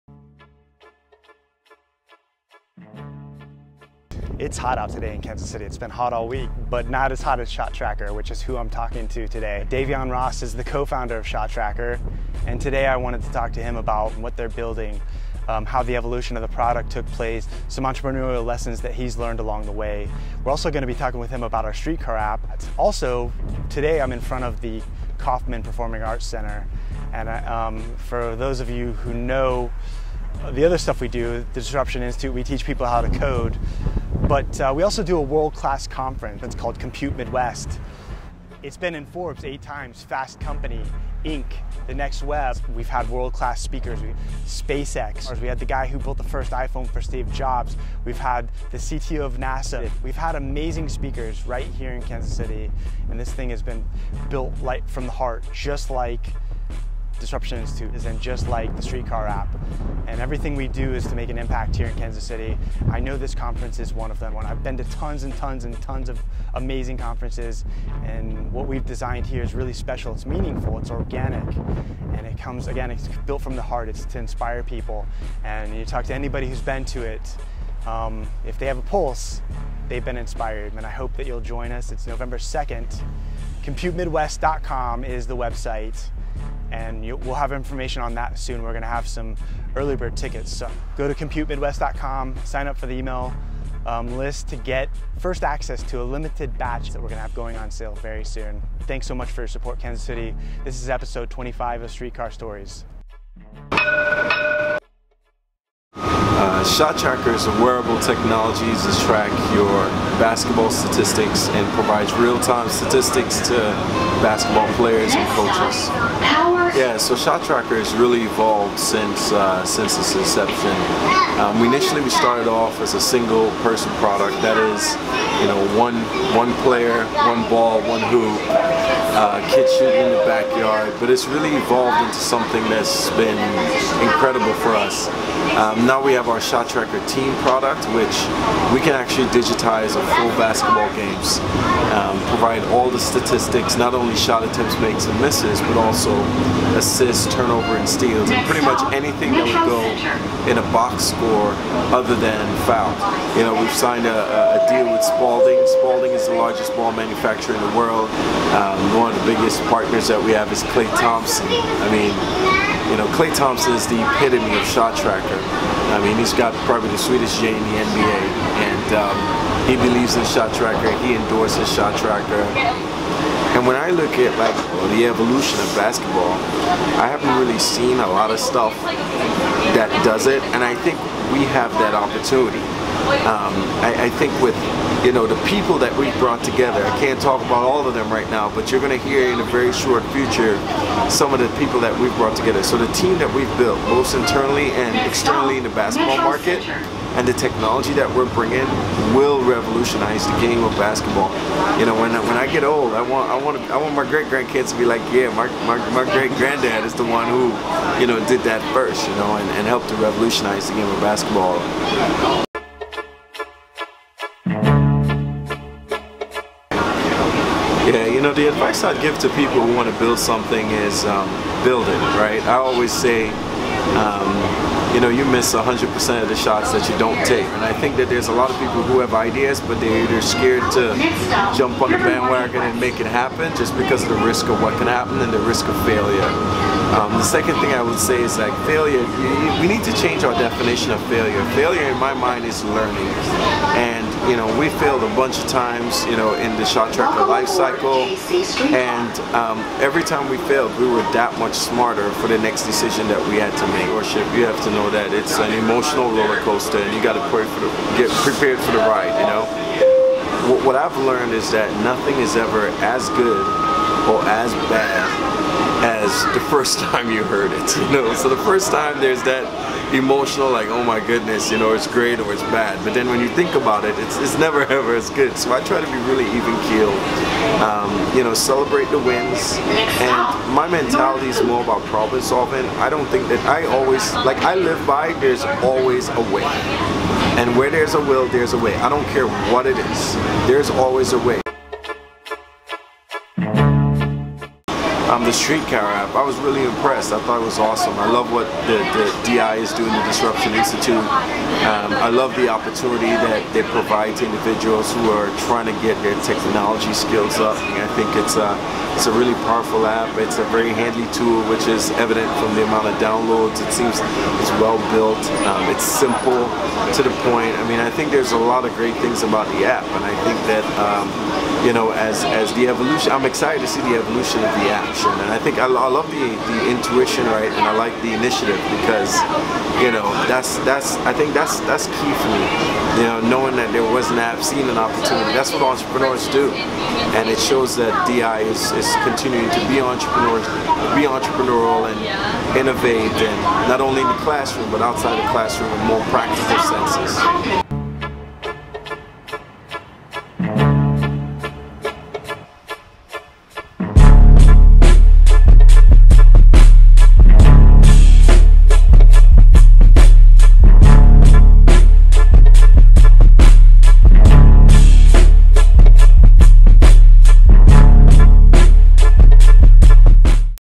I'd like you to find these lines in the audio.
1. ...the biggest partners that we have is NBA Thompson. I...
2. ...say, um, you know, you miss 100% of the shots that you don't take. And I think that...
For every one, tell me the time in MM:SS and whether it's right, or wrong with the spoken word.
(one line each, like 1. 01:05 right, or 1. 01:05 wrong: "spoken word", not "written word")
1. 02:39 wrong: "Klay", not "NBA"
2. 03:42 right.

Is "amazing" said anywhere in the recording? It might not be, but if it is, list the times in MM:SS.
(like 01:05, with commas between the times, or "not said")
00:50, 01:06.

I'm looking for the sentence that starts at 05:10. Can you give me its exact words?
It's a very handy tool, which is evident from the amount of downloads.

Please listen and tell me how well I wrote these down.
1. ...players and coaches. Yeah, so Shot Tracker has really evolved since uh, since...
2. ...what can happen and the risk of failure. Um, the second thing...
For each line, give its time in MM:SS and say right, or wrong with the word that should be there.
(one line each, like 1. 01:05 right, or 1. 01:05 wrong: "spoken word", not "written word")
1. 01:54 right
2. 03:54 right.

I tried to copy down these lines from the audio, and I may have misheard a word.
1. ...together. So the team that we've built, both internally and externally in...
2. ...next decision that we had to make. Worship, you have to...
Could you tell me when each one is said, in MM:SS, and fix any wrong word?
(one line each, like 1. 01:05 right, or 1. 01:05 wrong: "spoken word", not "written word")
1. 03:12 right
2. 04:12 right.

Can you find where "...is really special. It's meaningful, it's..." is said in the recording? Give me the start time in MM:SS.
01:09.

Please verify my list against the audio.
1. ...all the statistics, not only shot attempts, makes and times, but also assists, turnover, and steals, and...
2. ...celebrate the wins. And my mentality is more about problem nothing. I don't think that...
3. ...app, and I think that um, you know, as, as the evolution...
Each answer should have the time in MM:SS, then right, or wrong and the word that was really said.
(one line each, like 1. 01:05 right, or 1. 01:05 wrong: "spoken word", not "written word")
1. 02:22 wrong: "misses", not "times"
2. 04:38 wrong: "solving", not "nothing"
3. 05:19 right.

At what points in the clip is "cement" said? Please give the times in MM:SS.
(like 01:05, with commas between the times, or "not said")
not said.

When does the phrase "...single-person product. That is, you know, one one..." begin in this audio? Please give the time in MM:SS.
02:03.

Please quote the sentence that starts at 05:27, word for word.
And I like the initiative because, you know, that's, that's, I think that's, that's key for me.